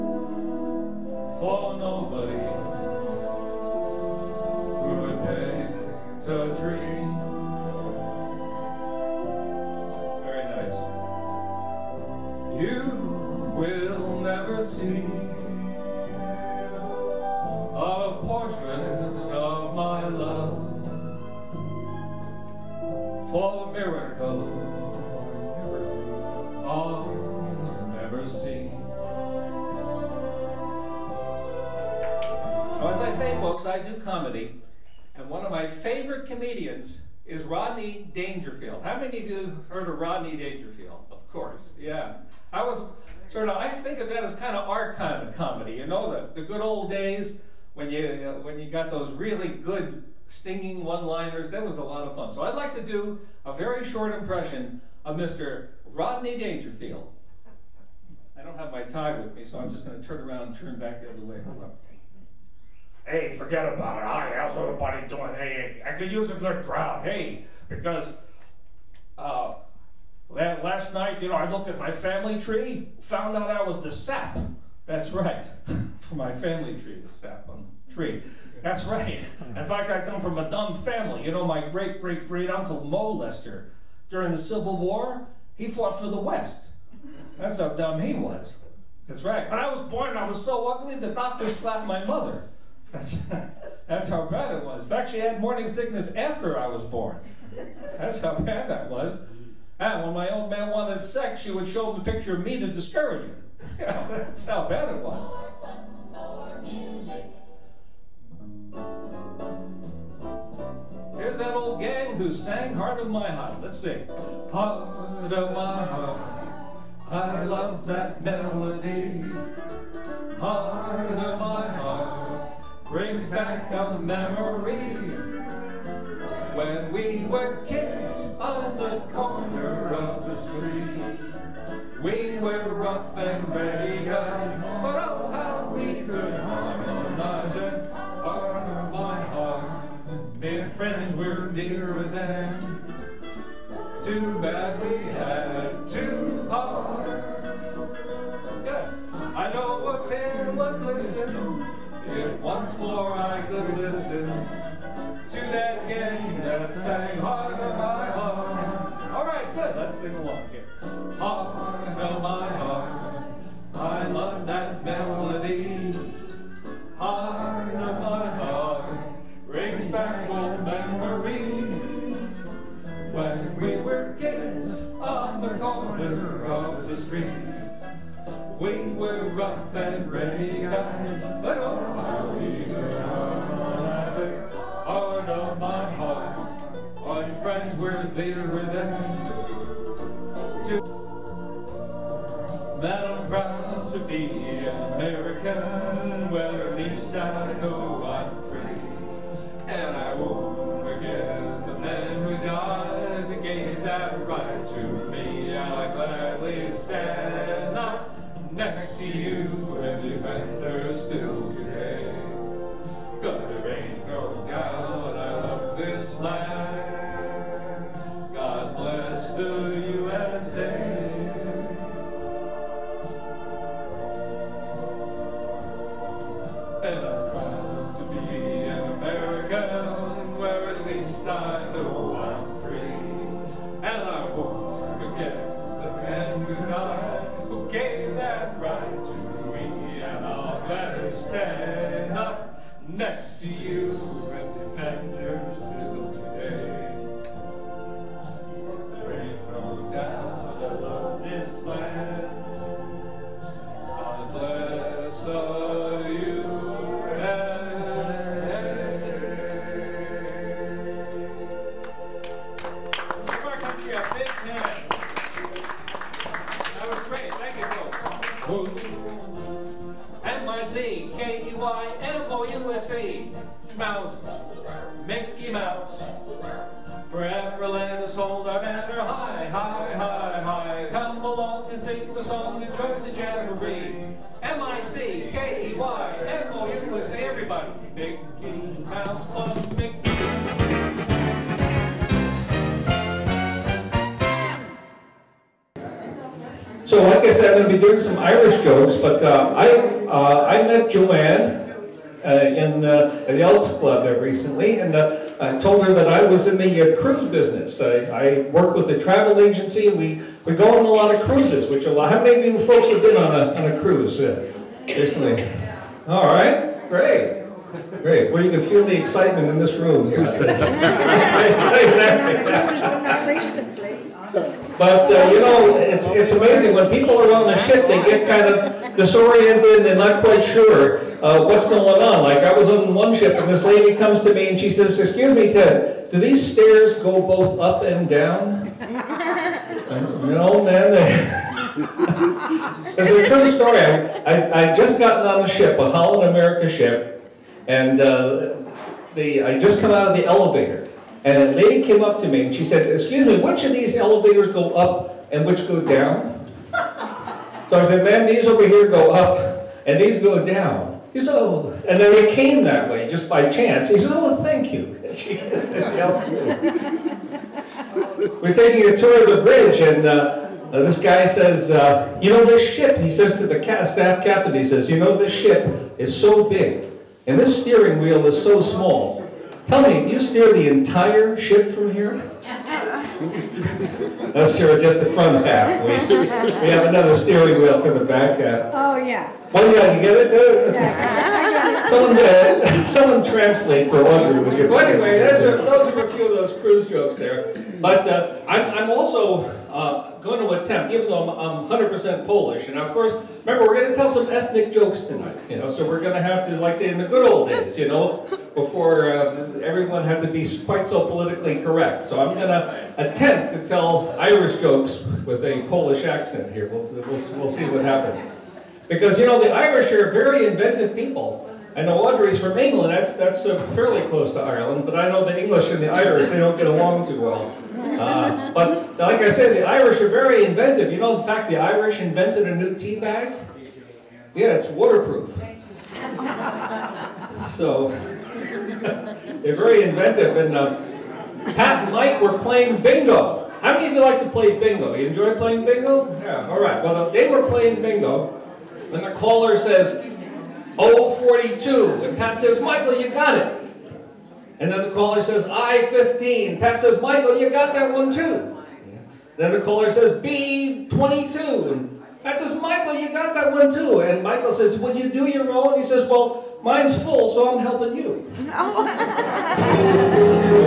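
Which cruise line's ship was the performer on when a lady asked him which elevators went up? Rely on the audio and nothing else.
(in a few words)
Holland America.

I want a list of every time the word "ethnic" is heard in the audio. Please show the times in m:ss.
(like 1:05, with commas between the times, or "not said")
6:44.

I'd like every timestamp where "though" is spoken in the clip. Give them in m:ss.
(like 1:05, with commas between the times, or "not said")
6:41.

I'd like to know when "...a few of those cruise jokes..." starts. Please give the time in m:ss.
6:36.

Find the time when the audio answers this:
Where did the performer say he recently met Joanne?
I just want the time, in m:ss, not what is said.
5:03.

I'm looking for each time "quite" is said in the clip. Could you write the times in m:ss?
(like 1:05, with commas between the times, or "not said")
5:30, 6:50.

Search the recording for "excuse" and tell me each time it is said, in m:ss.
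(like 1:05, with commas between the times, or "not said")
5:34, 5:52.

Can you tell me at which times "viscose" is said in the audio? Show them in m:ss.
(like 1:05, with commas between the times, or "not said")
not said.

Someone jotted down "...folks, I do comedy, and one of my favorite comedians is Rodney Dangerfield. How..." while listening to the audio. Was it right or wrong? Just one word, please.
right.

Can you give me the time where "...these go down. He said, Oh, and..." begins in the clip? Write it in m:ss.
5:59.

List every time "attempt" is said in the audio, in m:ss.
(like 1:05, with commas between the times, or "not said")
6:40, 6:52.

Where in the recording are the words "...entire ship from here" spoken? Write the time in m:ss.
6:20.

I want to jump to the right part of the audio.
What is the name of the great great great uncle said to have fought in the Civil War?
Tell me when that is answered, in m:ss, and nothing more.
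1:22.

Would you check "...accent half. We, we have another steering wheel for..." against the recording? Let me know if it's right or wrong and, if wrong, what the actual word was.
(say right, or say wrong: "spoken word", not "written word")
wrong: "front", not "accent".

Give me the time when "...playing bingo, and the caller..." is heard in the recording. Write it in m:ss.
7:27.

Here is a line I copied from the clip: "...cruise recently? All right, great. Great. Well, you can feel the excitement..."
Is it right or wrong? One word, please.
right.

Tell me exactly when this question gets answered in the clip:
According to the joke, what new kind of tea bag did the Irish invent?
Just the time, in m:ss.
7:14.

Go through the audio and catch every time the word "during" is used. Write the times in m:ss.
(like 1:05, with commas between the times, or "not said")
1:24.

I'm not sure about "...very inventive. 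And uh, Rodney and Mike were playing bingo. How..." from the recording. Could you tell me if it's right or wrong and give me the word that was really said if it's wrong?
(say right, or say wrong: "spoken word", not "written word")
wrong: "Pat", not "Rodney".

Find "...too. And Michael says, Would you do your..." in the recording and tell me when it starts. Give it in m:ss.
7:43.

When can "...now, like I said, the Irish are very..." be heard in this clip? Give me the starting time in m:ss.
7:08.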